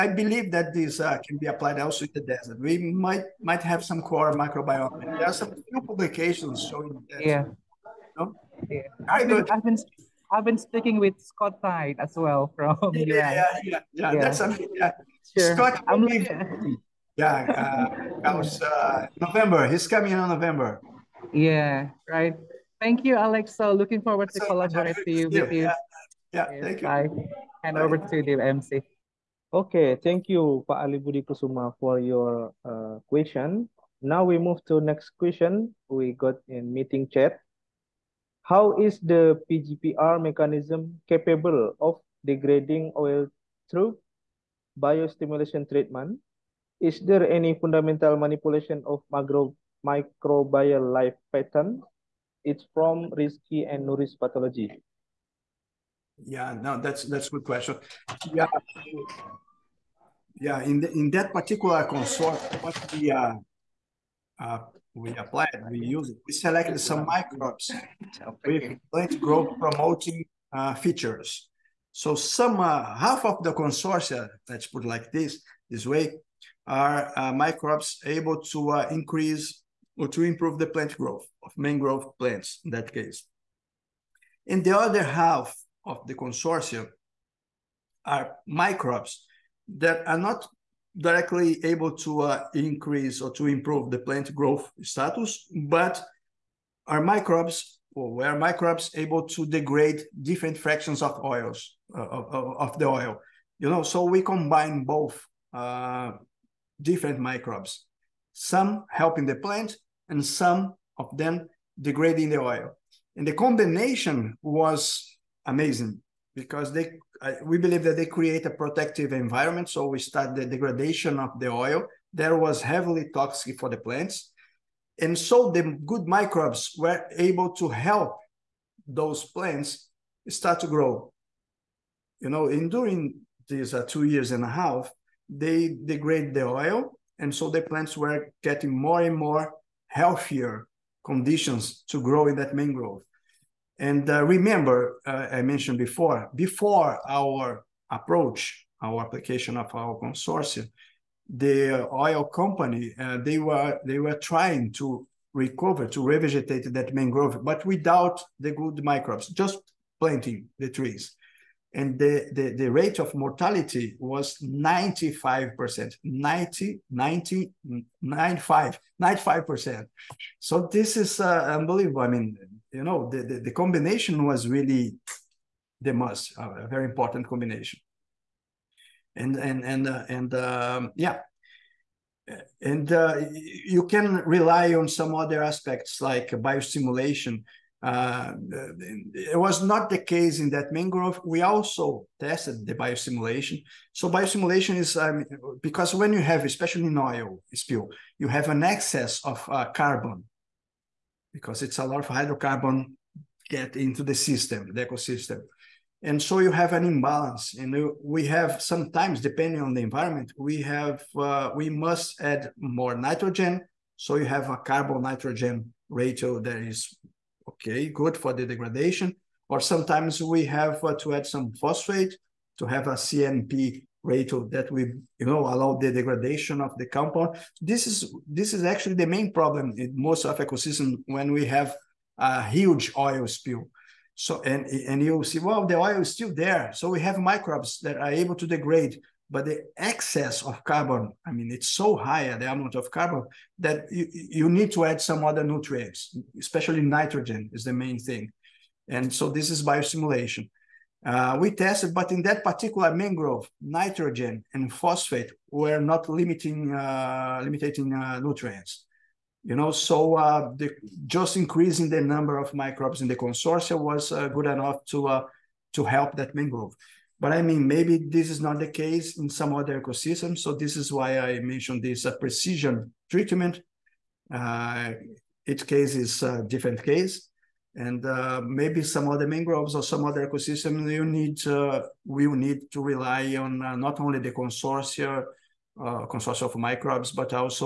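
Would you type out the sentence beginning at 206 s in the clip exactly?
And so you have an imbalance, and we have sometimes, depending on the environment, we have uh, we must add more nitrogen.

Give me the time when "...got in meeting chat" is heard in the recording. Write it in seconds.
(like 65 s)
36 s.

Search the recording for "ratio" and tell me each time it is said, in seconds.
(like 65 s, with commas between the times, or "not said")
215 s, 224 s.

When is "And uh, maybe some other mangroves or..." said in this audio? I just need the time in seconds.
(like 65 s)
277 s.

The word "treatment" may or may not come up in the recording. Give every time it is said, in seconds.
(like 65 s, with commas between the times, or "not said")
45 s, 273 s.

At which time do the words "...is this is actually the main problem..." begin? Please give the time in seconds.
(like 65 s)
227 s.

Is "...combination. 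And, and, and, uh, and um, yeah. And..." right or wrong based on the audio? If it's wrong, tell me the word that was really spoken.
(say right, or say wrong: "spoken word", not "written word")
right.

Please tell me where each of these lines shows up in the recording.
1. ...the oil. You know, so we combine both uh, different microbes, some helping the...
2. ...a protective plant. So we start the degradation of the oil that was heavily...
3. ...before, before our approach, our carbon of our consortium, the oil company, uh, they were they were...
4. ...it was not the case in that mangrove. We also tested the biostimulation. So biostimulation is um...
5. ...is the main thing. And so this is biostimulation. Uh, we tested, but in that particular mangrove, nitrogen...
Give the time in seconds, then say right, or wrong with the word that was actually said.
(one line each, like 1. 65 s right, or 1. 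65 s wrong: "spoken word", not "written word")
1. 102 s right
2. 118 s wrong: "environment", not "plant"
3. 145 s wrong: "application", not "carbon"
4. 189 s right
5. 247 s right.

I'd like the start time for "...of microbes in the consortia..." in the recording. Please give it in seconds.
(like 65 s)
262 s.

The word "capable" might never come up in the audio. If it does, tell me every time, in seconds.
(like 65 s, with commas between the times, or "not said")
41 s.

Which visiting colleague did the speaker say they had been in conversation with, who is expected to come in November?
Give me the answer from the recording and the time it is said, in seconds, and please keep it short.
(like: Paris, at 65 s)
Scott Tighe, at 11 s.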